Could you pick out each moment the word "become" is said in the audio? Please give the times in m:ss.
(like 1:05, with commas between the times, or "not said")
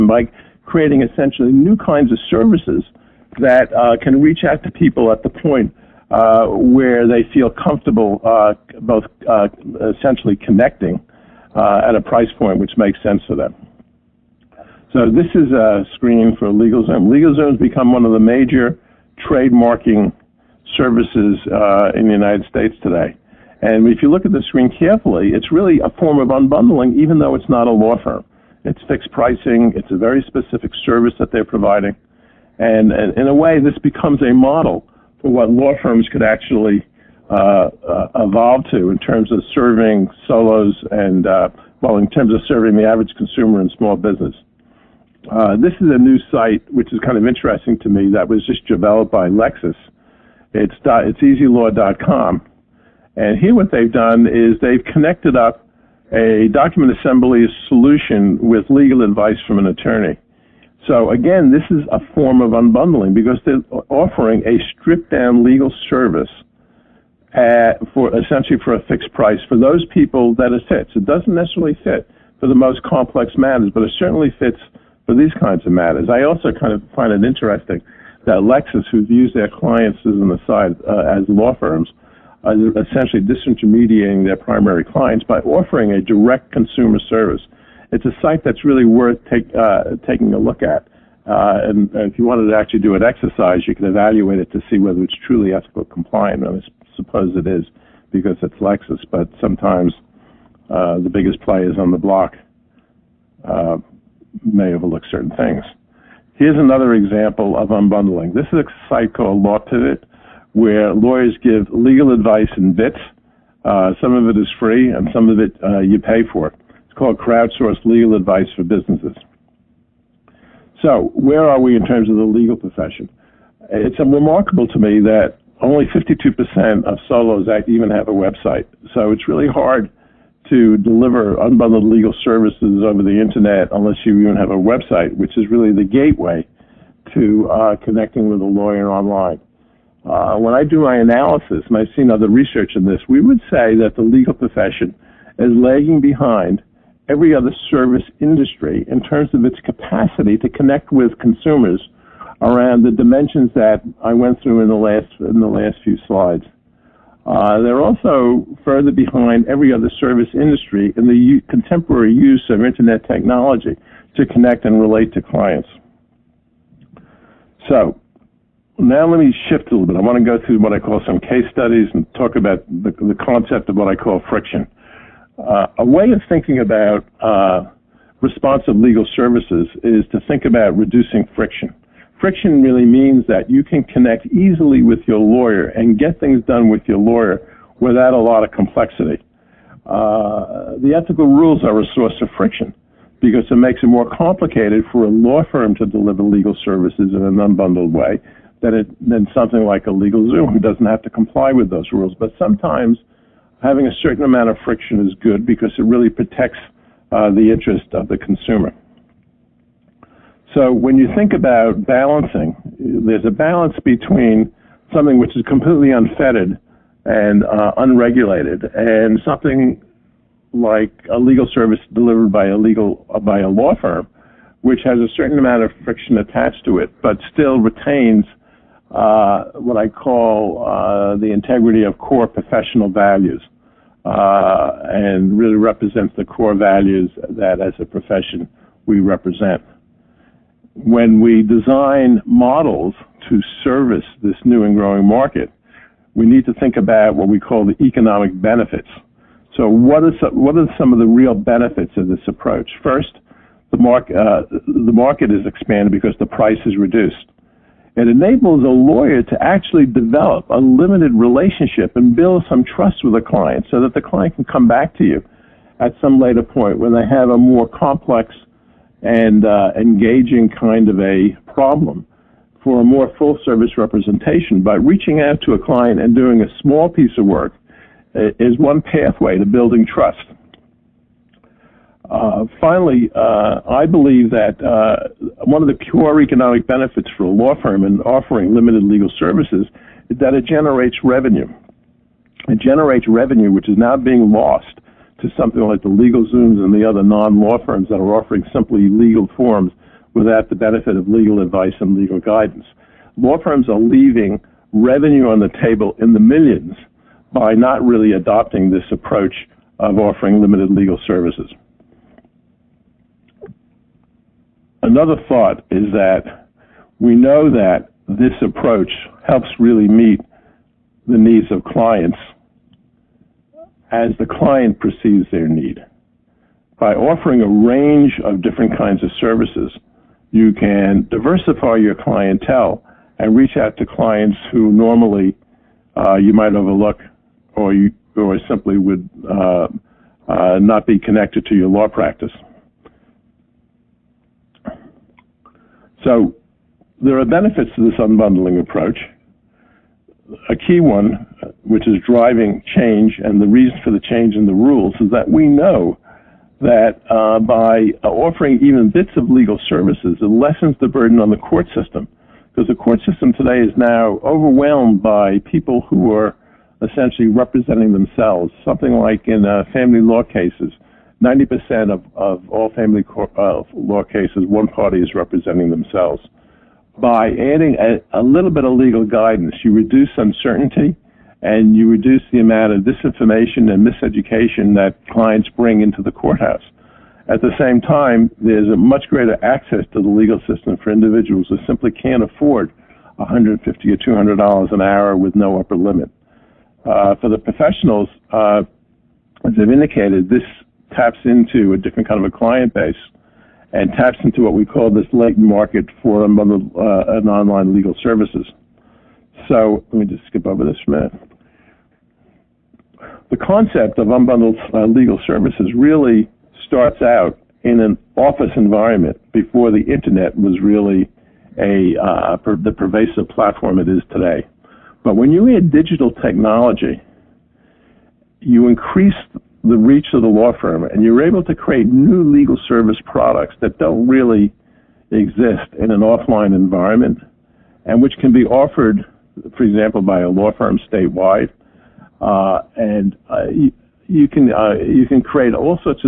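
0:17, 0:33.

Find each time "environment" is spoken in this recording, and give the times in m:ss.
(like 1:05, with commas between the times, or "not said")
6:58, 7:16.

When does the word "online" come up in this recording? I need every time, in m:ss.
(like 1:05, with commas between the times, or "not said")
2:18, 6:47.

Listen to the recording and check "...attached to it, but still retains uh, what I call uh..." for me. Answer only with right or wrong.
right.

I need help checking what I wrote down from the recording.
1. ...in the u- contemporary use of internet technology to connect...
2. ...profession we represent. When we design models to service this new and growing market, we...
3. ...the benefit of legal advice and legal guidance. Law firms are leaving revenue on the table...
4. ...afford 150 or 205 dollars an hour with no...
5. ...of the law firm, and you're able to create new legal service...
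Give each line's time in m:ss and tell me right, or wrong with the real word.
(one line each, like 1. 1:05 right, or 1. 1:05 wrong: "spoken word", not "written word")
1. 2:40 right
2. 3:57 right
3. 5:00 right
4. 6:32 wrong: "200", not "205"
5. 7:10 right.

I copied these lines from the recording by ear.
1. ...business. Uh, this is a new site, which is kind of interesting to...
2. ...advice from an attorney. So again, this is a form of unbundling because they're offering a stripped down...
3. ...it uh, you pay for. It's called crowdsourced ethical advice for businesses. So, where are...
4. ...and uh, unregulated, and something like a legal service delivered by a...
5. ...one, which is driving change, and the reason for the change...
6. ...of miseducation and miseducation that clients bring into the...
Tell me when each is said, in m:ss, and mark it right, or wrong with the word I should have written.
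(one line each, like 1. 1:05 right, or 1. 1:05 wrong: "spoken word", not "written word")
1. 0:43 right
2. 0:59 right
3. 1:55 wrong: "legal", not "ethical"
4. 3:37 right
5. 5:50 right
6. 6:22 wrong: "disinformation", not "miseducation".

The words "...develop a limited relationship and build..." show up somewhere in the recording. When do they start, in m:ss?
4:19.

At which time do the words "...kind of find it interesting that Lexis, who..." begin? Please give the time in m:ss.
1:16.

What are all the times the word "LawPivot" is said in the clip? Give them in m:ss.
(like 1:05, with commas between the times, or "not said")
1:49.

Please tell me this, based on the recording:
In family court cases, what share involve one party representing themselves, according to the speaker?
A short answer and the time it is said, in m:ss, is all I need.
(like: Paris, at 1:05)
90%, at 6:11.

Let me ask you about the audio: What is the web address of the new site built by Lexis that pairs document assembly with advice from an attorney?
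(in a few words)
easylaw.com.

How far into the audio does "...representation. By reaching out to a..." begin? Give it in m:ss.
4:33.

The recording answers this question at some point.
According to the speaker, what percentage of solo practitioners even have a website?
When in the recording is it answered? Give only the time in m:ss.
2:05.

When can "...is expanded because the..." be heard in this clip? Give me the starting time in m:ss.
4:15.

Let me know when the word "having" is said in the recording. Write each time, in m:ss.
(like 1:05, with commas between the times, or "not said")
3:23.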